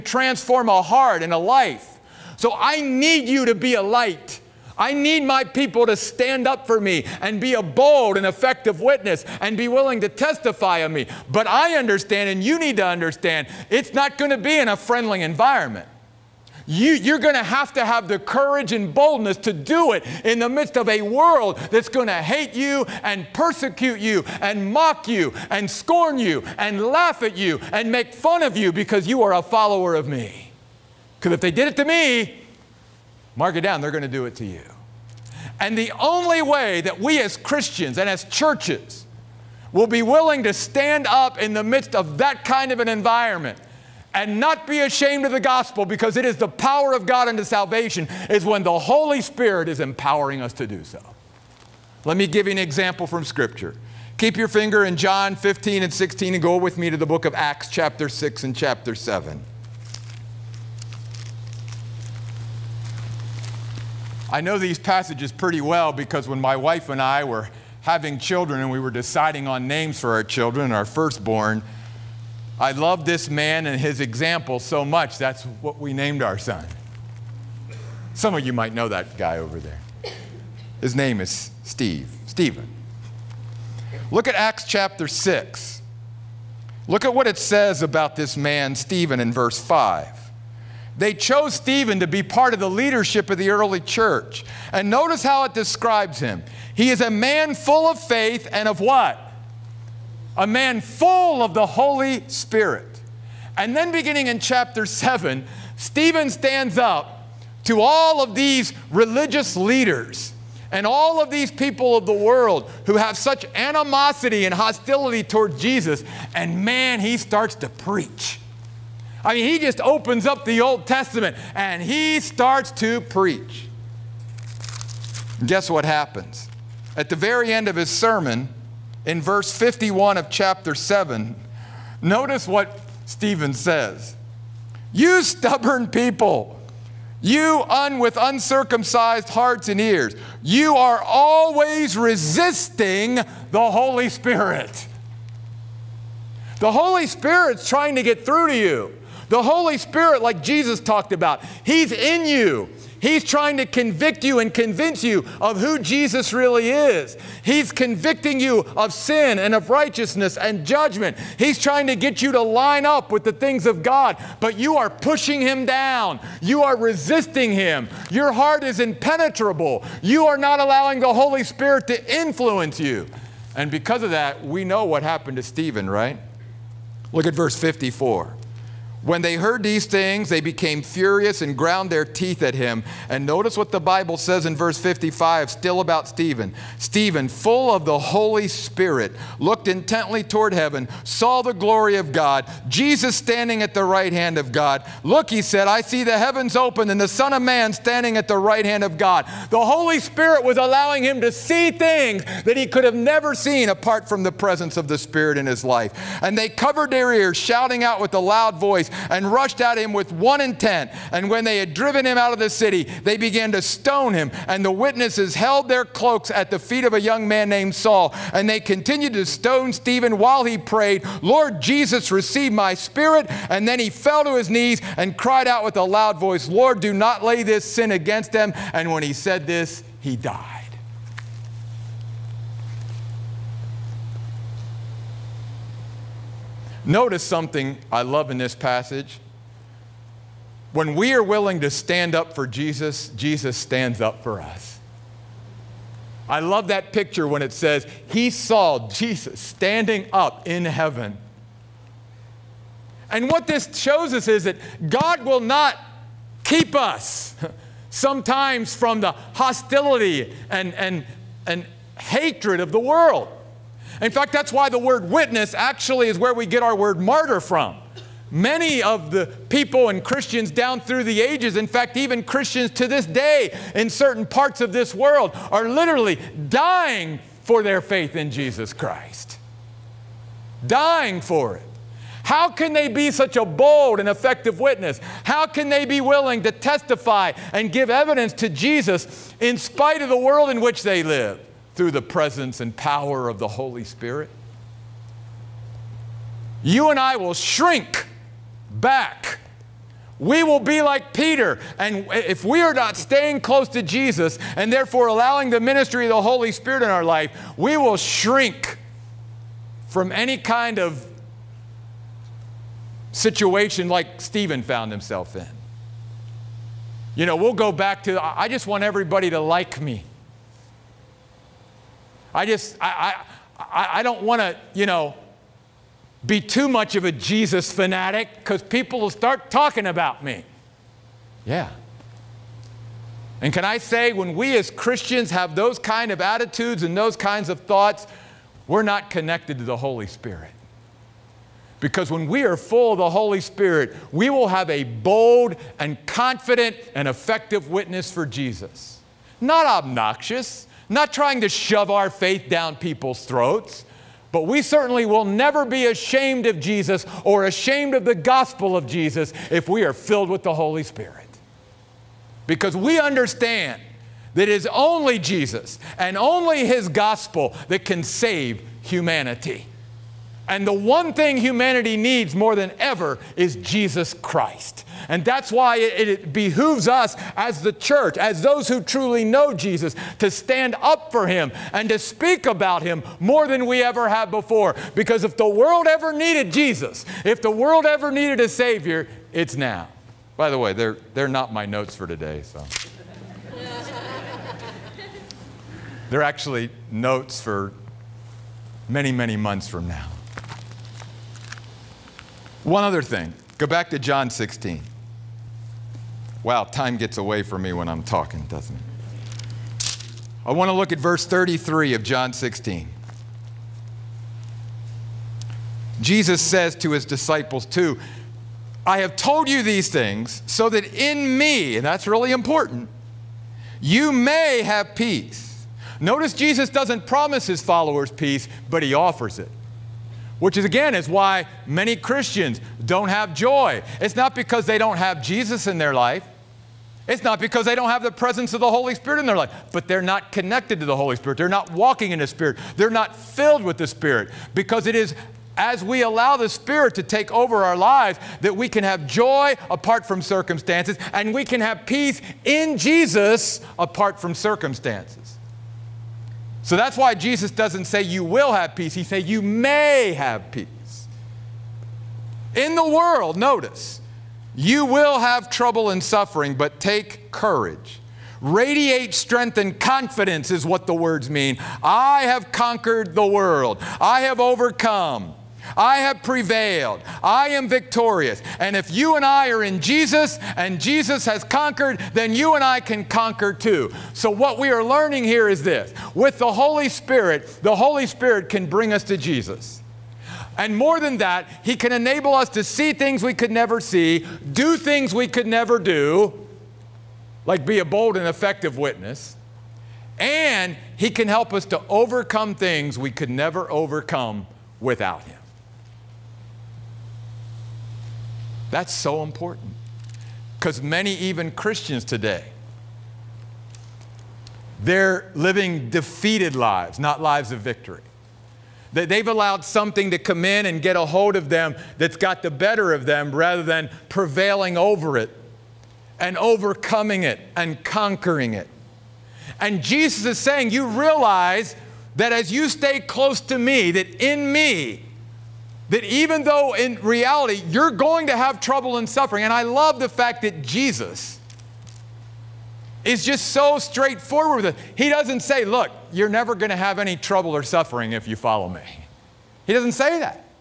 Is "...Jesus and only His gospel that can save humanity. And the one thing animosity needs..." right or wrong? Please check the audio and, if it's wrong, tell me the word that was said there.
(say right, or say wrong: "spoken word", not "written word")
wrong: "humanity", not "animosity".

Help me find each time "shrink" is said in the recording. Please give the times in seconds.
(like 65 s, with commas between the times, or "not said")
297 s, 307 s.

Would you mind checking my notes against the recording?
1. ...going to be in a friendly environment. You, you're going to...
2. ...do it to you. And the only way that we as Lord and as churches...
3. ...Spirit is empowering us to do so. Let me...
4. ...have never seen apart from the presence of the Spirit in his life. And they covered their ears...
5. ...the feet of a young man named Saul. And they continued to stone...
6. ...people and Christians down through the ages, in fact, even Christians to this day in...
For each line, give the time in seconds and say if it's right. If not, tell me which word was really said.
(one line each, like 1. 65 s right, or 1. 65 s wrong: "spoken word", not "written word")
1. 14 s right
2. 34 s wrong: "Christians", not "Lord"
3. 49 s right
4. 202 s right
5. 216 s right
6. 269 s right.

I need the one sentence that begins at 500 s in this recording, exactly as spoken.
And He can help us to overcome things we could never overcome without Him.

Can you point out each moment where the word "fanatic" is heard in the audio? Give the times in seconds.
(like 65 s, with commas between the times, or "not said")
327 s.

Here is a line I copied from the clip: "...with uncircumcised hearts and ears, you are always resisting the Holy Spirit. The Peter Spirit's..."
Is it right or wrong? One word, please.
wrong.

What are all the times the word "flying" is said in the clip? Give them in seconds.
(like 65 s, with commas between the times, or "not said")
not said.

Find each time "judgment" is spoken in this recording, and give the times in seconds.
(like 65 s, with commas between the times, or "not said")
160 s.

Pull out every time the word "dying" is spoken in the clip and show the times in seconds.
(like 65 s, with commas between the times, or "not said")
276 s, 280 s.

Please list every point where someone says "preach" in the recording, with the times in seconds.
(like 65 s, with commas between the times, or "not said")
117 s, 123 s.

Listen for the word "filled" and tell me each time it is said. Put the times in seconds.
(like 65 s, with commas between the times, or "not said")
359 s, 443 s.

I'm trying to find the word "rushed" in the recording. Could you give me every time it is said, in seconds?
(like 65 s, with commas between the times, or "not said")
209 s.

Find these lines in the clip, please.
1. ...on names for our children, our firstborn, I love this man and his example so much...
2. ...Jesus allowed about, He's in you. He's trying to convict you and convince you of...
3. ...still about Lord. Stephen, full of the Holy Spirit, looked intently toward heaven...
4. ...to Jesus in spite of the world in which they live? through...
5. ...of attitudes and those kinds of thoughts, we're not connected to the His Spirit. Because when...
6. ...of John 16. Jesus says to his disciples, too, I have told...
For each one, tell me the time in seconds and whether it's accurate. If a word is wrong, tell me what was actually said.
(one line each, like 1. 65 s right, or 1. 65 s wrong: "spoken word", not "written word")
1. 69 s right
2. 150 s wrong: "talked", not "allowed"
3. 185 s wrong: "Stephen", not "Lord"
4. 288 s right
5. 336 s wrong: "Holy", not "His"
6. 411 s right.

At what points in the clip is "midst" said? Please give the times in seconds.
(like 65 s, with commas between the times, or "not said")
20 s, 41 s.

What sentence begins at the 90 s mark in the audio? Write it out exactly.
They chose Stephen to be part of the leadership of the early church.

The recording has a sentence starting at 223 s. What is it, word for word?
And then he fell to his knees and cried out with a loud voice, Lord, do not lay this sin against them.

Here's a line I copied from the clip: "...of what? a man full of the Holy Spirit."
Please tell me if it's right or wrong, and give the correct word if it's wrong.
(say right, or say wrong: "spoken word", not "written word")
right.